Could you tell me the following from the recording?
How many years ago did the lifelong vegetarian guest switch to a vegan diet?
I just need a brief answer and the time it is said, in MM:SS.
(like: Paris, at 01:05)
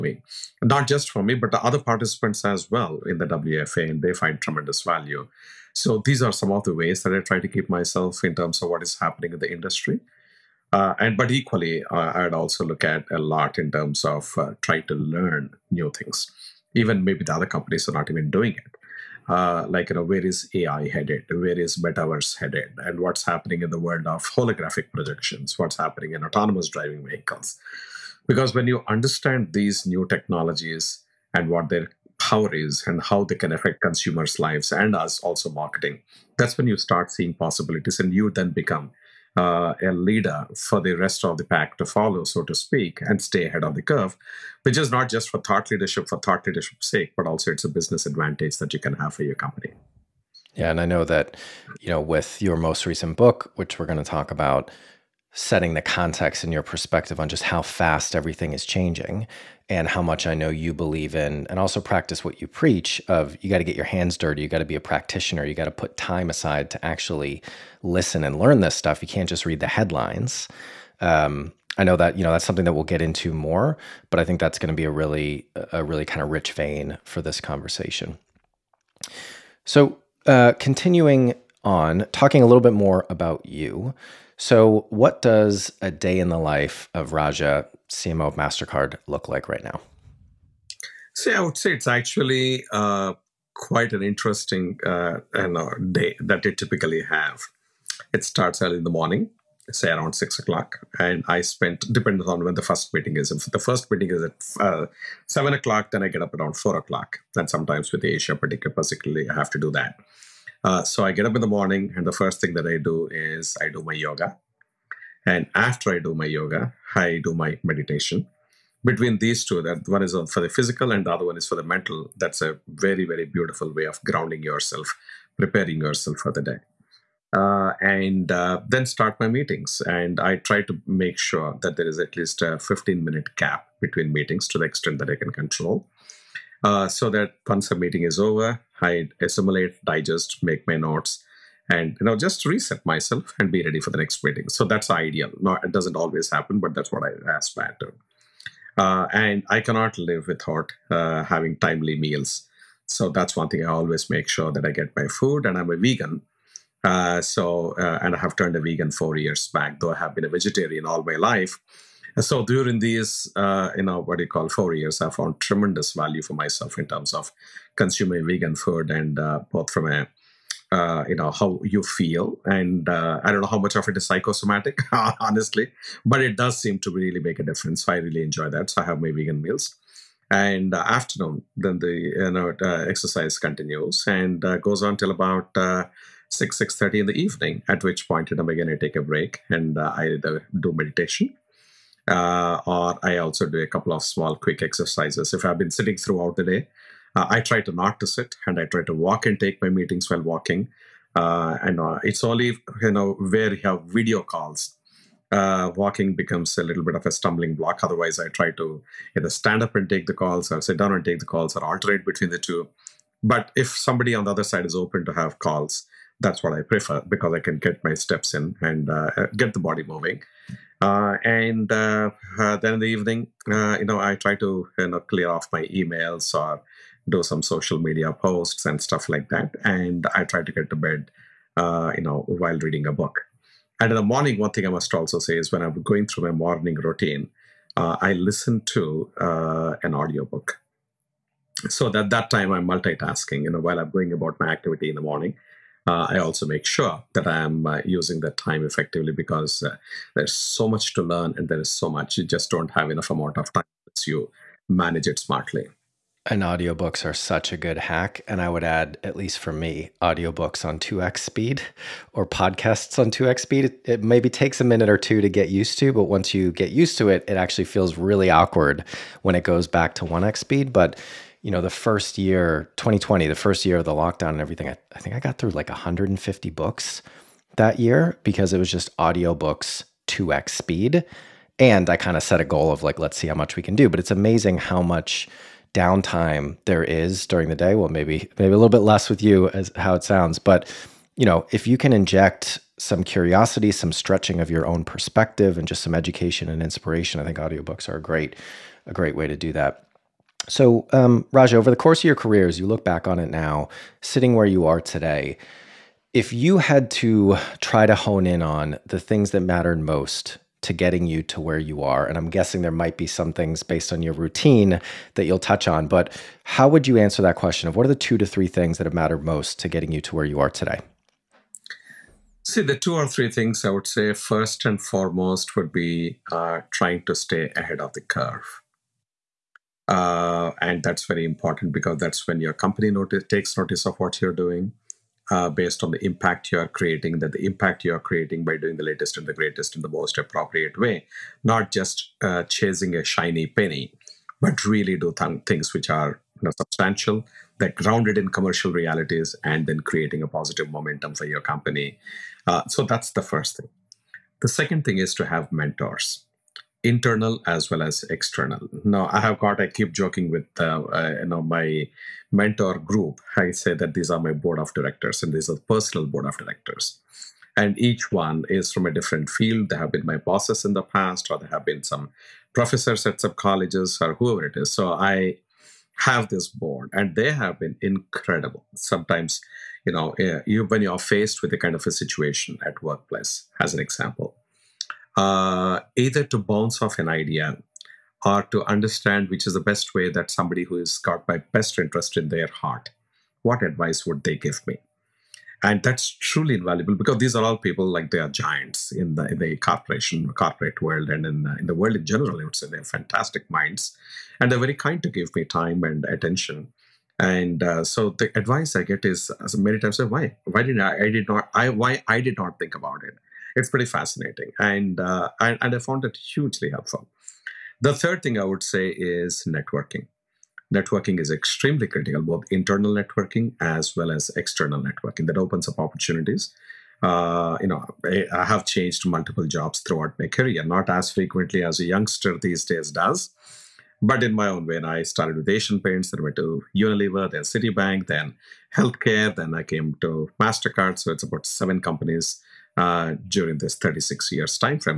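4 years, at 02:38.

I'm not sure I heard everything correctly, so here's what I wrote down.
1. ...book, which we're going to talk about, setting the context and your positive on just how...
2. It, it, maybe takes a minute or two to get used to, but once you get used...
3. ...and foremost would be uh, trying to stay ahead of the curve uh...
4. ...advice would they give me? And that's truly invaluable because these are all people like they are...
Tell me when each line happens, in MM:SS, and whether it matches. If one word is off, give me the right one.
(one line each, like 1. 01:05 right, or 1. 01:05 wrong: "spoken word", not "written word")
1. 00:53 wrong: "perspective", not "positive"
2. 04:23 right
3. 05:24 right
4. 06:33 right.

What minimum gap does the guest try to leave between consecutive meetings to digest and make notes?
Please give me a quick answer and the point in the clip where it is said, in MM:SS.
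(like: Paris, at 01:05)
15 minutes, at 02:12.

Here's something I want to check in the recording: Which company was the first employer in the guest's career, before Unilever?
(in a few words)
Asian Paints.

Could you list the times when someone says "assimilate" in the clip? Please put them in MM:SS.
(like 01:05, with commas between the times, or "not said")
02:19.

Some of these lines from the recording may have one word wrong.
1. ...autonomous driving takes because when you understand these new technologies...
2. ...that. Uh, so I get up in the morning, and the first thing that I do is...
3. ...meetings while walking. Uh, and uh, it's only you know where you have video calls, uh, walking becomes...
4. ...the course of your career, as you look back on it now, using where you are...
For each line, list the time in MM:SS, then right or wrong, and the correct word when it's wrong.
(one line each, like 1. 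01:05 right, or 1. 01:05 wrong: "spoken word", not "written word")
1. 00:26 wrong: "vehicles", not "takes"
2. 01:49 right
3. 03:19 right
4. 05:01 wrong: "sitting", not "using".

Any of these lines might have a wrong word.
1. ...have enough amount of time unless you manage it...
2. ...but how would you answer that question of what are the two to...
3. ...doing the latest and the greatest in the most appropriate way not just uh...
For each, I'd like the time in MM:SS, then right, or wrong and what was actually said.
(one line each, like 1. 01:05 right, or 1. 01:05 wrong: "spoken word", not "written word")
1. 04:12 right
2. 05:15 right
3. 05:38 right.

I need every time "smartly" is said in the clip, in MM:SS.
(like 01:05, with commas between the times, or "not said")
04:15.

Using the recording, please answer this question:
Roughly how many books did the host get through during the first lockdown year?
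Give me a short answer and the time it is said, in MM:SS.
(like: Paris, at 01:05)
150, at 04:35.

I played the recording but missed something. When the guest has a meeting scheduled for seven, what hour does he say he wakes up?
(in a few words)
4 o'clock.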